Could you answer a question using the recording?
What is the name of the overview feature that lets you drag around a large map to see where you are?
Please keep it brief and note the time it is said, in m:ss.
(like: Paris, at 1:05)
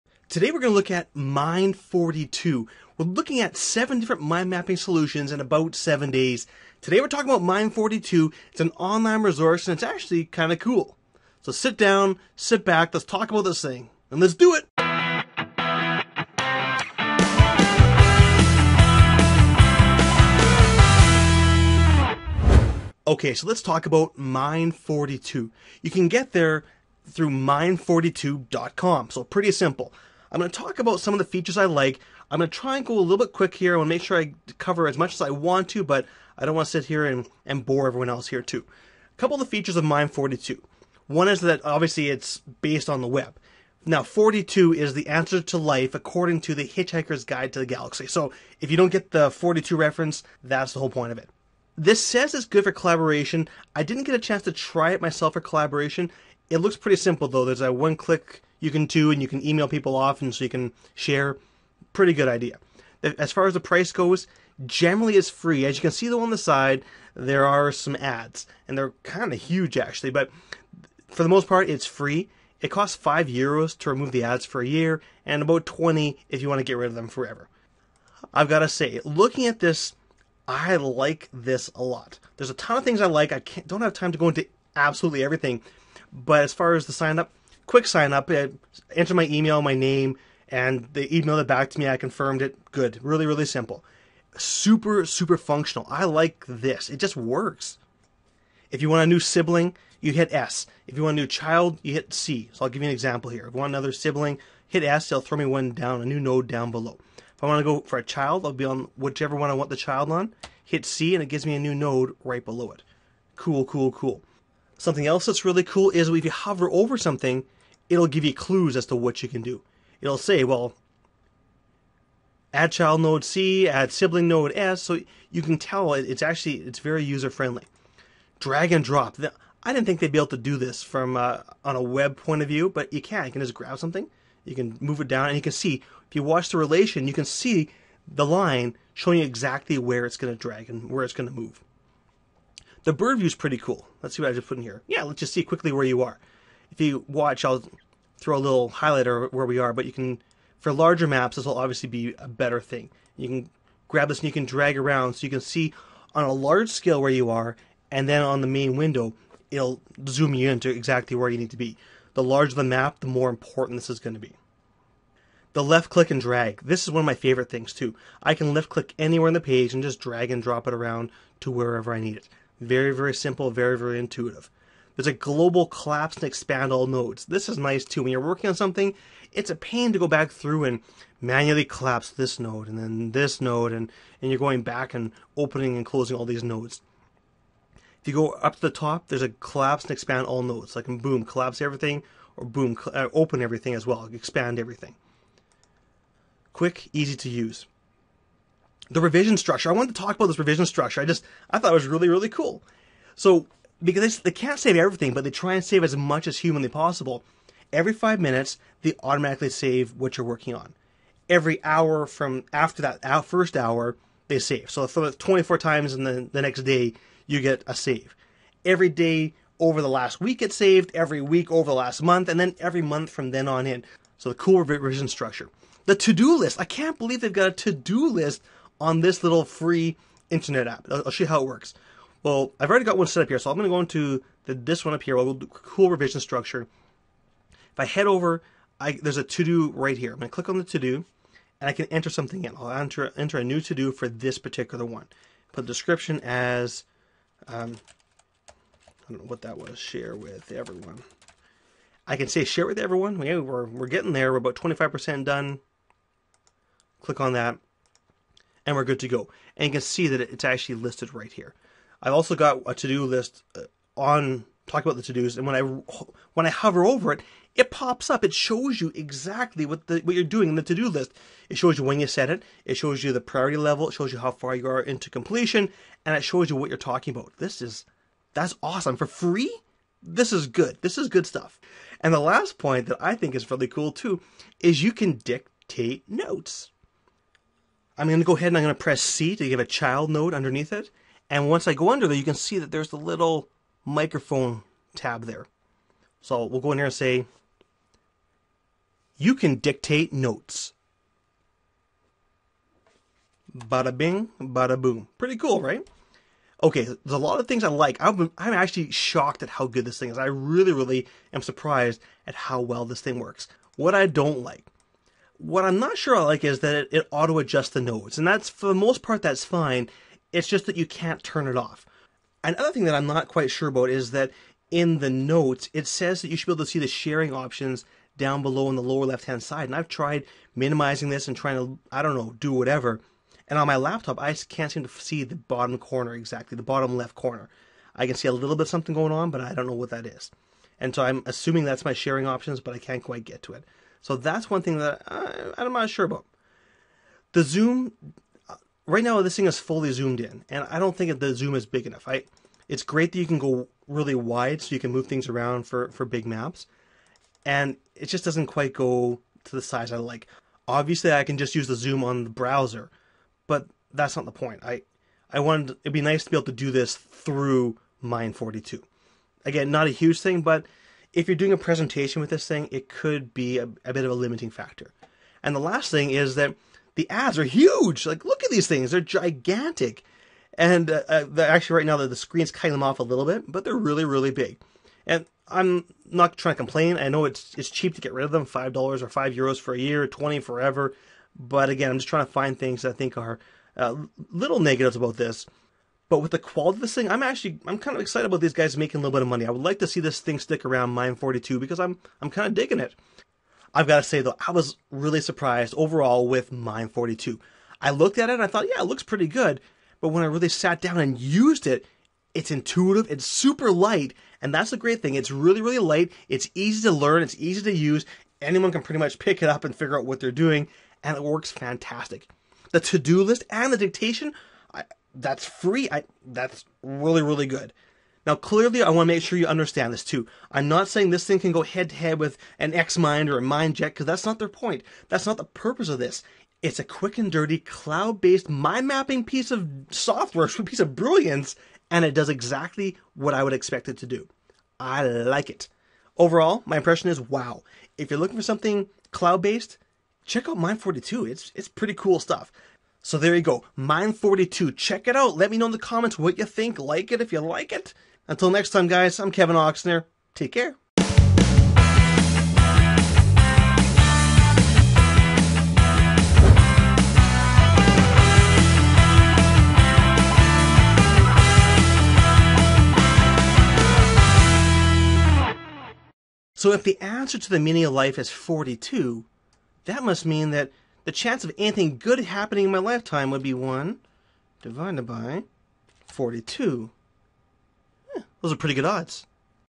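bird view, at 2:22.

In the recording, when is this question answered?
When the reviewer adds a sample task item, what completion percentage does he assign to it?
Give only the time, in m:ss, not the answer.
4:14.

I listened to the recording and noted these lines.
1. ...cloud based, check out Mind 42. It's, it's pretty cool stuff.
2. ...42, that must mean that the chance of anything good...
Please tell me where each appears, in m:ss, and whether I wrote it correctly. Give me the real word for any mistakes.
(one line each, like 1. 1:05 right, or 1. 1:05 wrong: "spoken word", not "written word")
1. 7:29 right
2. 7:58 right.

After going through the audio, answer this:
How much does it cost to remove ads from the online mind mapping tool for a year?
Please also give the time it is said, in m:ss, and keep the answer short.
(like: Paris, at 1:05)
5 euros, at 1:12.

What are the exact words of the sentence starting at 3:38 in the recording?
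Every day over the last week, it saved.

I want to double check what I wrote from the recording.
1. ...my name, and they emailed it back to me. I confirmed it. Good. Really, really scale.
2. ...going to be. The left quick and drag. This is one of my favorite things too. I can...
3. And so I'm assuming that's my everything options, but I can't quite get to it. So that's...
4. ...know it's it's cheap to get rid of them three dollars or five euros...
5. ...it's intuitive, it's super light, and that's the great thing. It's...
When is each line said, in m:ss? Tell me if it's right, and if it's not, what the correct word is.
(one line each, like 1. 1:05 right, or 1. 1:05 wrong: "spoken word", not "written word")
1. 1:29 wrong: "simple", not "scale"
2. 2:43 wrong: "click", not "quick"
3. 5:40 wrong: "sharing", not "everything"
4. 6:27 wrong: "five", not "three"
5. 6:52 right.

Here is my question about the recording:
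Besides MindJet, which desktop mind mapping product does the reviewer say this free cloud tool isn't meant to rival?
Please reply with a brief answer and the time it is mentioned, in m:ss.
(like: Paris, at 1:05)
XMind, at 7:12.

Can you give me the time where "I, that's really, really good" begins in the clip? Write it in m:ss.
7:05.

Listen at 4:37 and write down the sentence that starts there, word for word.
This is that's awesome for free.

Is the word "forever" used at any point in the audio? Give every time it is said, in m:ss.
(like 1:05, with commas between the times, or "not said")
1:17, 6:30.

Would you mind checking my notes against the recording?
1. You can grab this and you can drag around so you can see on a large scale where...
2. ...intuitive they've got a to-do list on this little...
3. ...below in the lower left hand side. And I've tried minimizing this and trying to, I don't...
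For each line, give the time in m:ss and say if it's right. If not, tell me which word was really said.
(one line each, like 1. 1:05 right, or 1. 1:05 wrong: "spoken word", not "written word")
1. 2:33 right
2. 3:46 wrong: "believe", not "intuitive"
3. 5:28 right.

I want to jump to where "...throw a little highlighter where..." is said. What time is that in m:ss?
2:28.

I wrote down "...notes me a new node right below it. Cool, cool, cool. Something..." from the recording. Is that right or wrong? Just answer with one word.
wrong.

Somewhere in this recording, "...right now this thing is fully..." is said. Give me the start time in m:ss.
5:48.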